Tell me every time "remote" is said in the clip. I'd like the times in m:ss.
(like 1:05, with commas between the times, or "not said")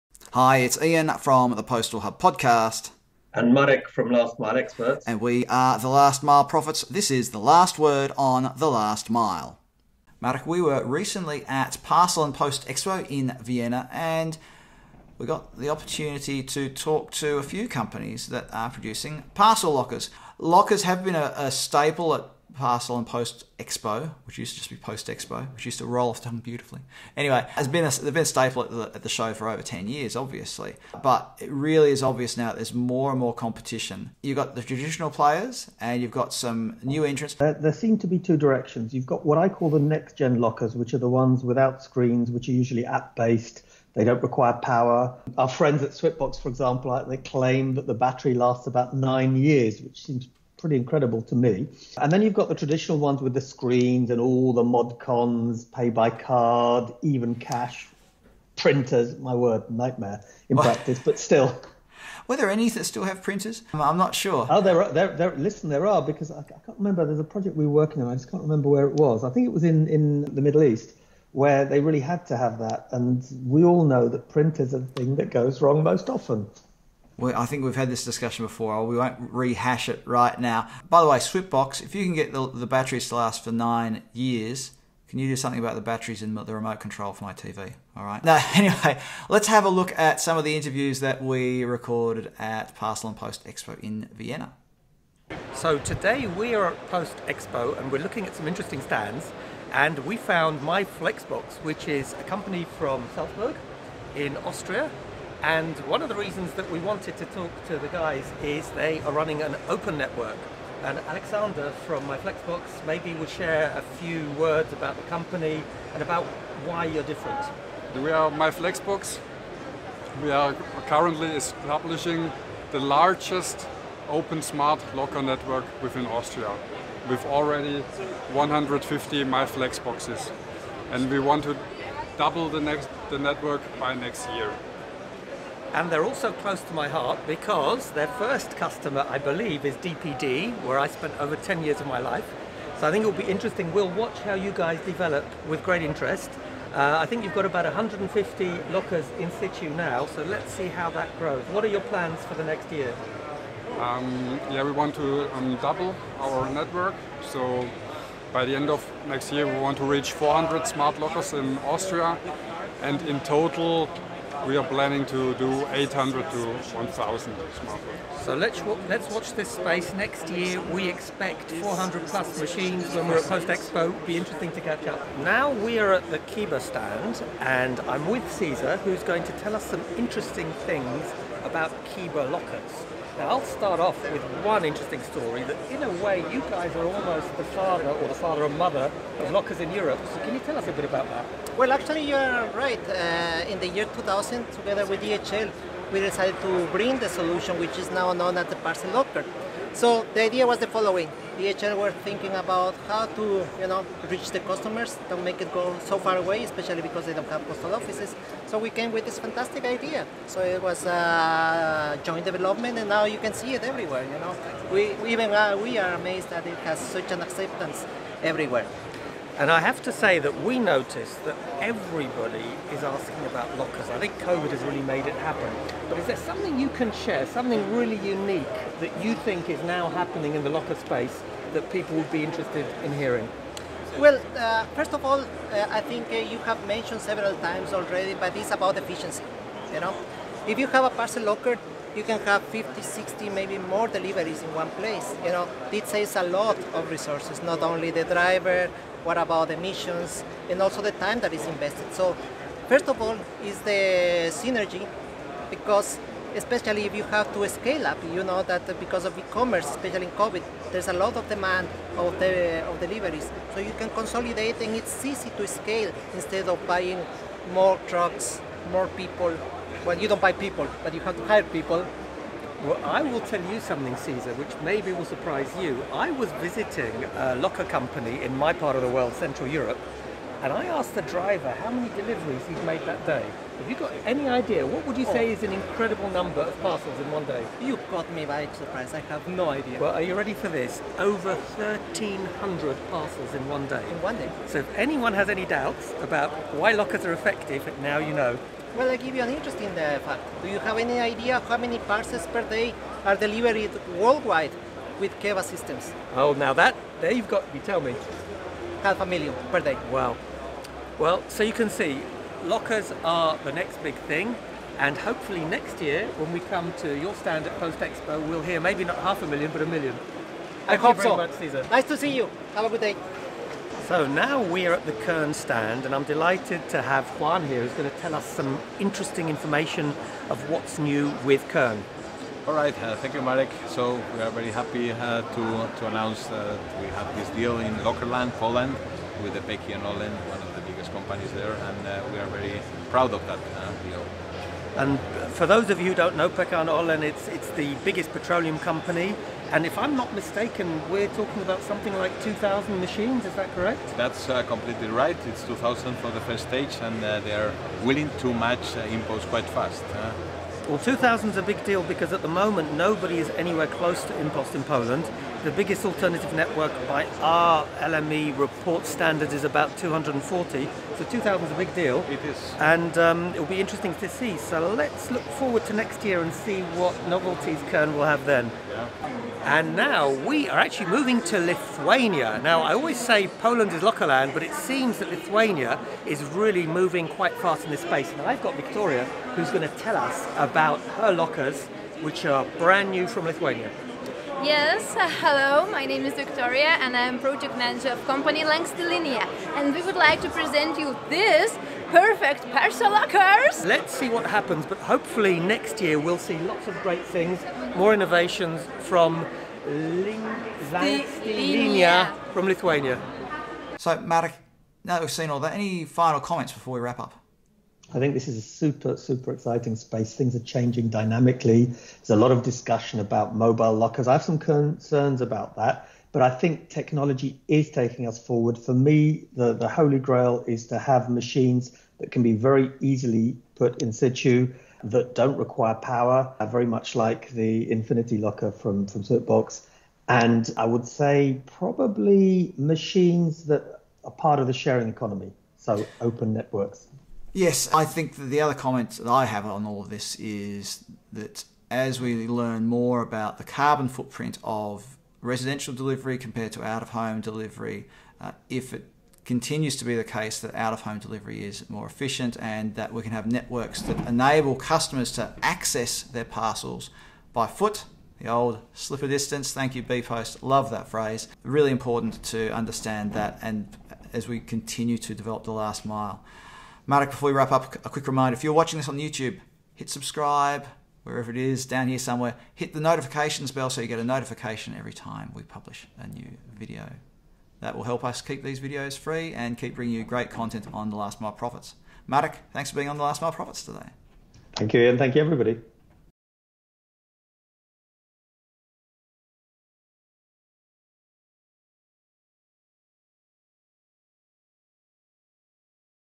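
1:26.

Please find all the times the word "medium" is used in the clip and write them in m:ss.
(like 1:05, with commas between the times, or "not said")
not said.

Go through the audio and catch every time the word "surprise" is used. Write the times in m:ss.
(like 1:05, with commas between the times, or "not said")
4:35, 4:48.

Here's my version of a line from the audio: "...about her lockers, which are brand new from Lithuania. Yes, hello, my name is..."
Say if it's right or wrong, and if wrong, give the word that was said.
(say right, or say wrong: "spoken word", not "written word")
right.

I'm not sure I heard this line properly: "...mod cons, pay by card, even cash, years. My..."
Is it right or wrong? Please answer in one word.
wrong.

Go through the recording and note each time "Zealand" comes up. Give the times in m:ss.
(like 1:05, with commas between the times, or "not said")
not said.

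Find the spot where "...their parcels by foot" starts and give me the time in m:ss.
7:46.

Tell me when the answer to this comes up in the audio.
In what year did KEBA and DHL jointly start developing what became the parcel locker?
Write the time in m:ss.
3:13.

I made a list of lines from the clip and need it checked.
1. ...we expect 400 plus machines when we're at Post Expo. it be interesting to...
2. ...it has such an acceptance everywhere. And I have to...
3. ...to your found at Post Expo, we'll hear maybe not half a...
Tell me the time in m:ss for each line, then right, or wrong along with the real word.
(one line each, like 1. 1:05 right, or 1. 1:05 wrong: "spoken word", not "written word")
1. 2:50 right
2. 3:36 right
3. 5:16 wrong: "stand", not "found".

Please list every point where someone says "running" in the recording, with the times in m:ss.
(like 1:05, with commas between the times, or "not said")
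1:49.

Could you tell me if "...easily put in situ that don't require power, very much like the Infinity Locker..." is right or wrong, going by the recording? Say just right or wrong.
right.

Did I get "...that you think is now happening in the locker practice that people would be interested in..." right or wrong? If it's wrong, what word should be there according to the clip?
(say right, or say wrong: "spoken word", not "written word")
wrong: "space", not "practice".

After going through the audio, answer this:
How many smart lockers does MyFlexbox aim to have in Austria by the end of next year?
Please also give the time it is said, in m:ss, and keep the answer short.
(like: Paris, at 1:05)
400, at 2:40.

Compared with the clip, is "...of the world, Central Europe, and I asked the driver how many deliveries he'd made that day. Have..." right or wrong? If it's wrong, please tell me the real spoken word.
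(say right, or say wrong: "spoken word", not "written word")
right.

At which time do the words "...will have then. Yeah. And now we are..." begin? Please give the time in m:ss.
6:17.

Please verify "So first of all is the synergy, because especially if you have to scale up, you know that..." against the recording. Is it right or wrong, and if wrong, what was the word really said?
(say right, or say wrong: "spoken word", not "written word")
right.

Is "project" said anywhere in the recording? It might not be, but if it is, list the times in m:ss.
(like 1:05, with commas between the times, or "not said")
1:07, 6:37.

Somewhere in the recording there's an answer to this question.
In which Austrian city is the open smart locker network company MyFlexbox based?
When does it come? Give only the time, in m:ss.
1:43.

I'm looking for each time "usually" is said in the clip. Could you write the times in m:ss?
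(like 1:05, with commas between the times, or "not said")
0:42.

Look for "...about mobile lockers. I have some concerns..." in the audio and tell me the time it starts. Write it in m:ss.
7:03.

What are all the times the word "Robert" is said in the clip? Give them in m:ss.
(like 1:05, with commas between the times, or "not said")
not said.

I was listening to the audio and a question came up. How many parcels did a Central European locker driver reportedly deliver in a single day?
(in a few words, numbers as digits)
Over 1,300.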